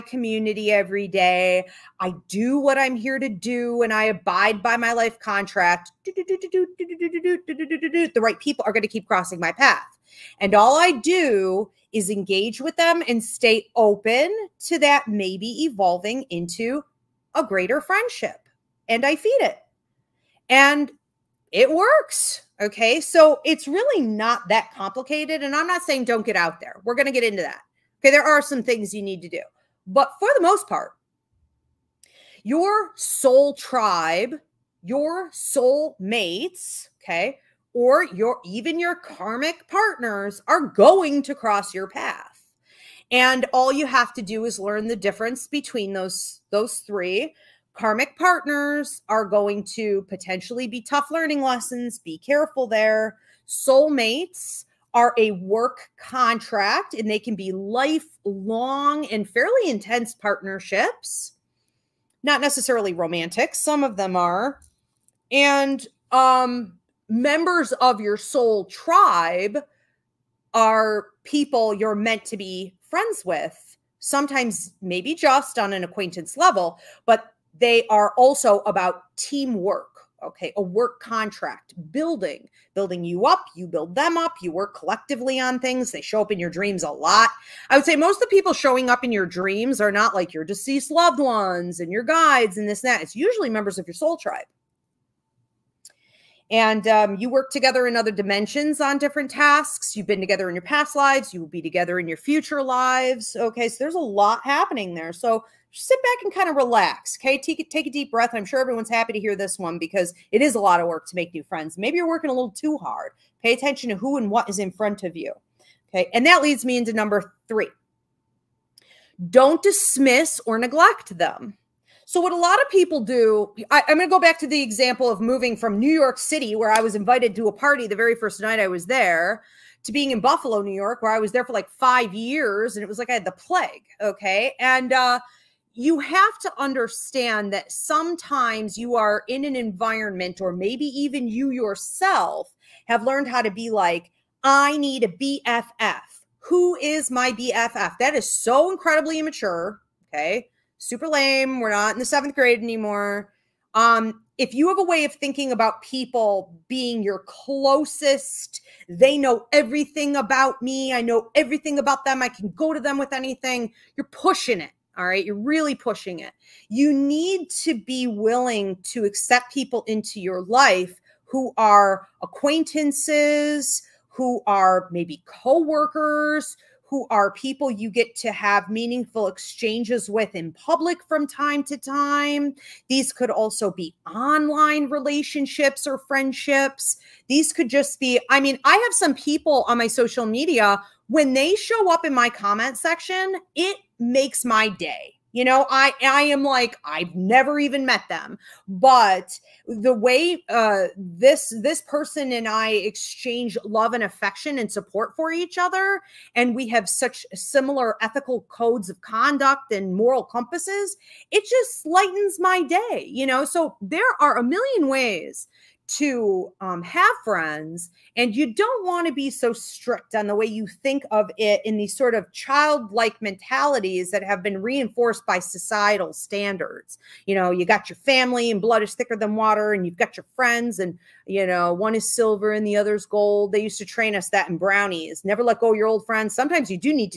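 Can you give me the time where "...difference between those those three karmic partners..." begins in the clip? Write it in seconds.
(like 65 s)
44 s.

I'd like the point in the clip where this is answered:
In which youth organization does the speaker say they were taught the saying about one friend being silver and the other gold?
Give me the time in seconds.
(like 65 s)
234 s.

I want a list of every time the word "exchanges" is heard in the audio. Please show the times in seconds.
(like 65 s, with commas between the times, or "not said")
179 s, 202 s.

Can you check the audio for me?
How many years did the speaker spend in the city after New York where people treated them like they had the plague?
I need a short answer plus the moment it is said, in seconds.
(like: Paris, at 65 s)
5, at 131 s.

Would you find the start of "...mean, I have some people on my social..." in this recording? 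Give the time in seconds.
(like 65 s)
188 s.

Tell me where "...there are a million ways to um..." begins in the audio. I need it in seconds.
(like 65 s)
213 s.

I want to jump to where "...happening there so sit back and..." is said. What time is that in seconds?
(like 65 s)
104 s.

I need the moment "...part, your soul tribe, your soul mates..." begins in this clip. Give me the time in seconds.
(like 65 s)
30 s.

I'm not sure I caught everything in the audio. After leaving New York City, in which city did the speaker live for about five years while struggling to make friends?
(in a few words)
Buffalo.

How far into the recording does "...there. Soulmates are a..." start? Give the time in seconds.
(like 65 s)
52 s.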